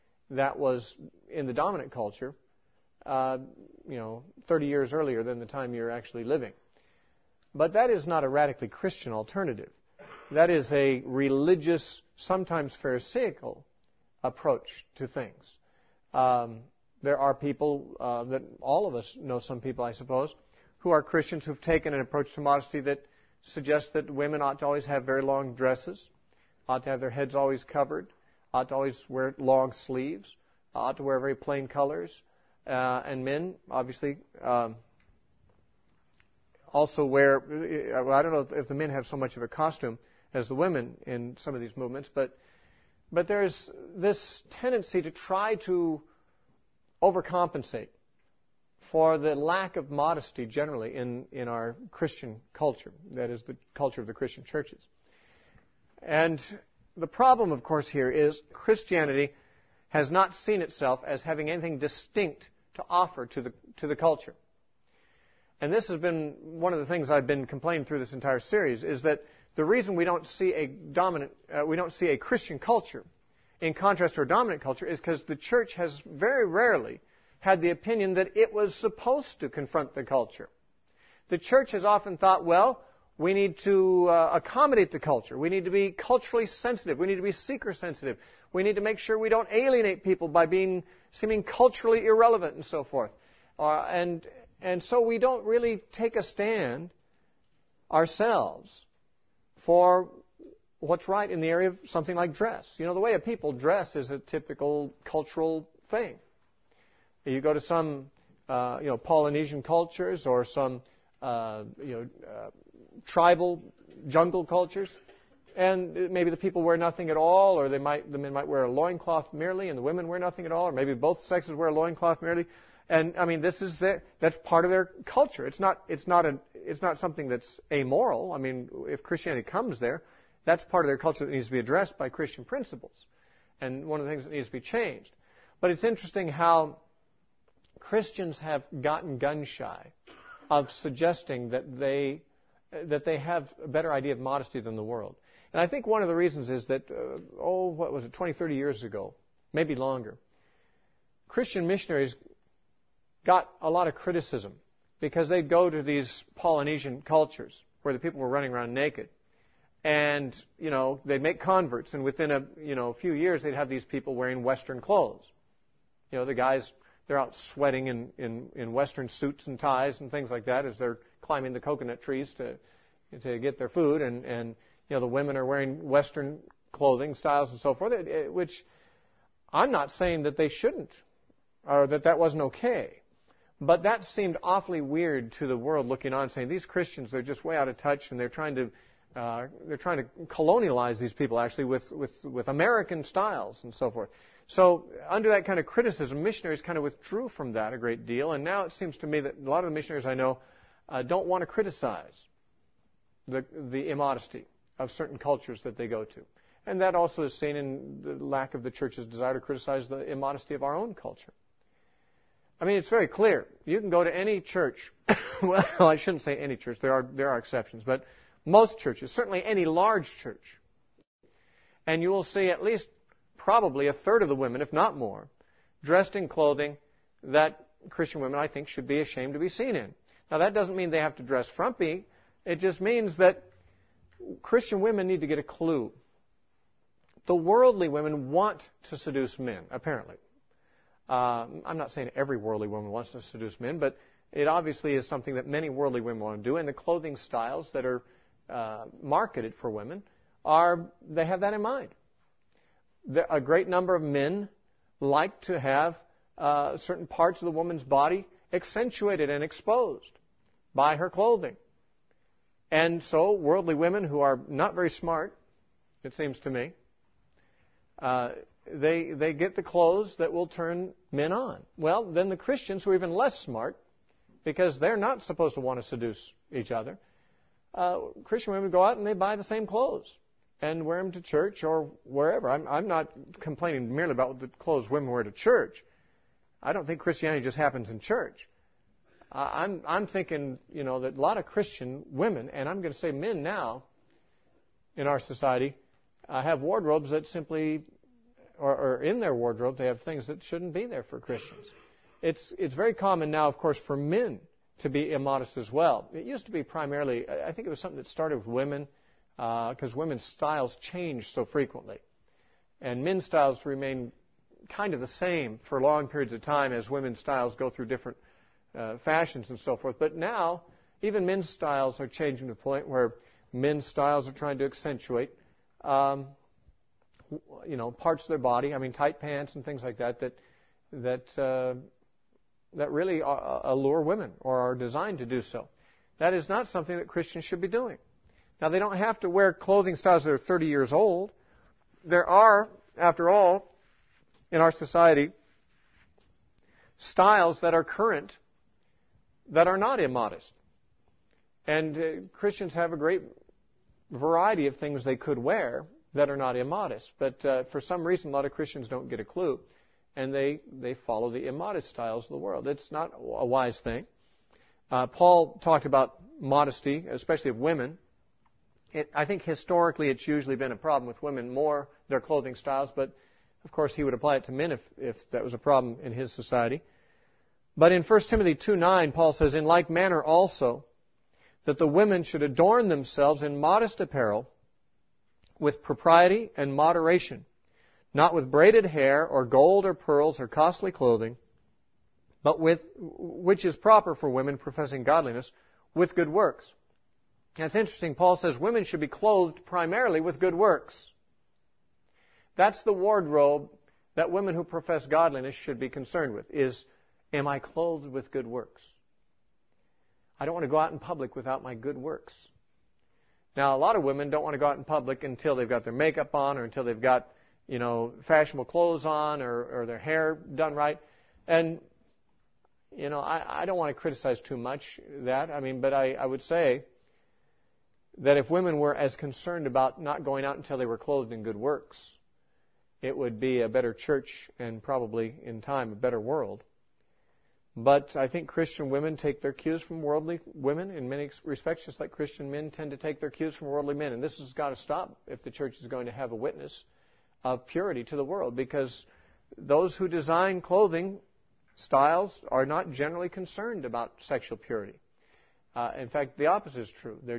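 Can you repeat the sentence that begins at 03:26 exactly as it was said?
And that also is seen in the lack of the church's desire to criticize the immodesty of our own culture.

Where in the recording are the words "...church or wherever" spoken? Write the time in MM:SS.
04:41.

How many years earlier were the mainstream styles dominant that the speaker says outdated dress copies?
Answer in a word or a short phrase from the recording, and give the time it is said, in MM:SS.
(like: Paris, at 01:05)
30, at 00:04.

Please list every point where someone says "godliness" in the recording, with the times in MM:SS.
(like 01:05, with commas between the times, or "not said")
06:35, 06:45.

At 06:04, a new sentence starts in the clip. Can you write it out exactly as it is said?
Uh, Paul talked about modesty, especially of women.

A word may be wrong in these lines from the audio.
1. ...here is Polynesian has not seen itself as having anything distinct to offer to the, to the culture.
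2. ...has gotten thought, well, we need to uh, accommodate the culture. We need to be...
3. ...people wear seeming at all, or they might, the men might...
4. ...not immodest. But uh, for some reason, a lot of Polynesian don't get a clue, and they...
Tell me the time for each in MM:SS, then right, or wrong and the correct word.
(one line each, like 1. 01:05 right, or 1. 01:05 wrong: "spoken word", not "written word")
1. 00:57 wrong: "Christianity", not "Polynesian"
2. 01:21 wrong: "often", not "gotten"
3. 01:56 wrong: "nothing", not "seeming"
4. 05:56 wrong: "Christians", not "Polynesian".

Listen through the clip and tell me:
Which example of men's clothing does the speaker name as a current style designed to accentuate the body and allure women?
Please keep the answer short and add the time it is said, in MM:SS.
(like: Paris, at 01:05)
tight pants, at 05:28.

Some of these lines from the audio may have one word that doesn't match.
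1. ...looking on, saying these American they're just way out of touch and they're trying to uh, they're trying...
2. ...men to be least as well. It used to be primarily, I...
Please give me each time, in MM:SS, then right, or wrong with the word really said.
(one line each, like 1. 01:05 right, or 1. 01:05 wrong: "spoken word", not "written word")
1. 03:05 wrong: "Christians", not "American"
2. 05:03 wrong: "immodest", not "least".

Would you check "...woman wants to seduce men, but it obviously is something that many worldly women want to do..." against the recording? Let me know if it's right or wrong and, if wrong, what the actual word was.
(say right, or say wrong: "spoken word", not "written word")
right.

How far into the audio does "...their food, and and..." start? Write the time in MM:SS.
02:53.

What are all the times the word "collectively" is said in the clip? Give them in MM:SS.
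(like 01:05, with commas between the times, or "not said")
not said.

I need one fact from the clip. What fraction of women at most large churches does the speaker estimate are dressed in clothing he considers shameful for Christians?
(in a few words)
a third.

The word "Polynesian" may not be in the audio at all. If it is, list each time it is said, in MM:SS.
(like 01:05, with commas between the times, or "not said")
01:48, 02:36.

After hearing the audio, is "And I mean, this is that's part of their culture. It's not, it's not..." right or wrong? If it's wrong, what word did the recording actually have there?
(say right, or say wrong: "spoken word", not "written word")
right.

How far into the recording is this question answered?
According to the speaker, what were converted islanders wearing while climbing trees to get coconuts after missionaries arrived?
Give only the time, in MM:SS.
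02:48.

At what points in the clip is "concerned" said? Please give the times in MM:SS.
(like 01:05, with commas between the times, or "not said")
06:45, 07:09, 07:33.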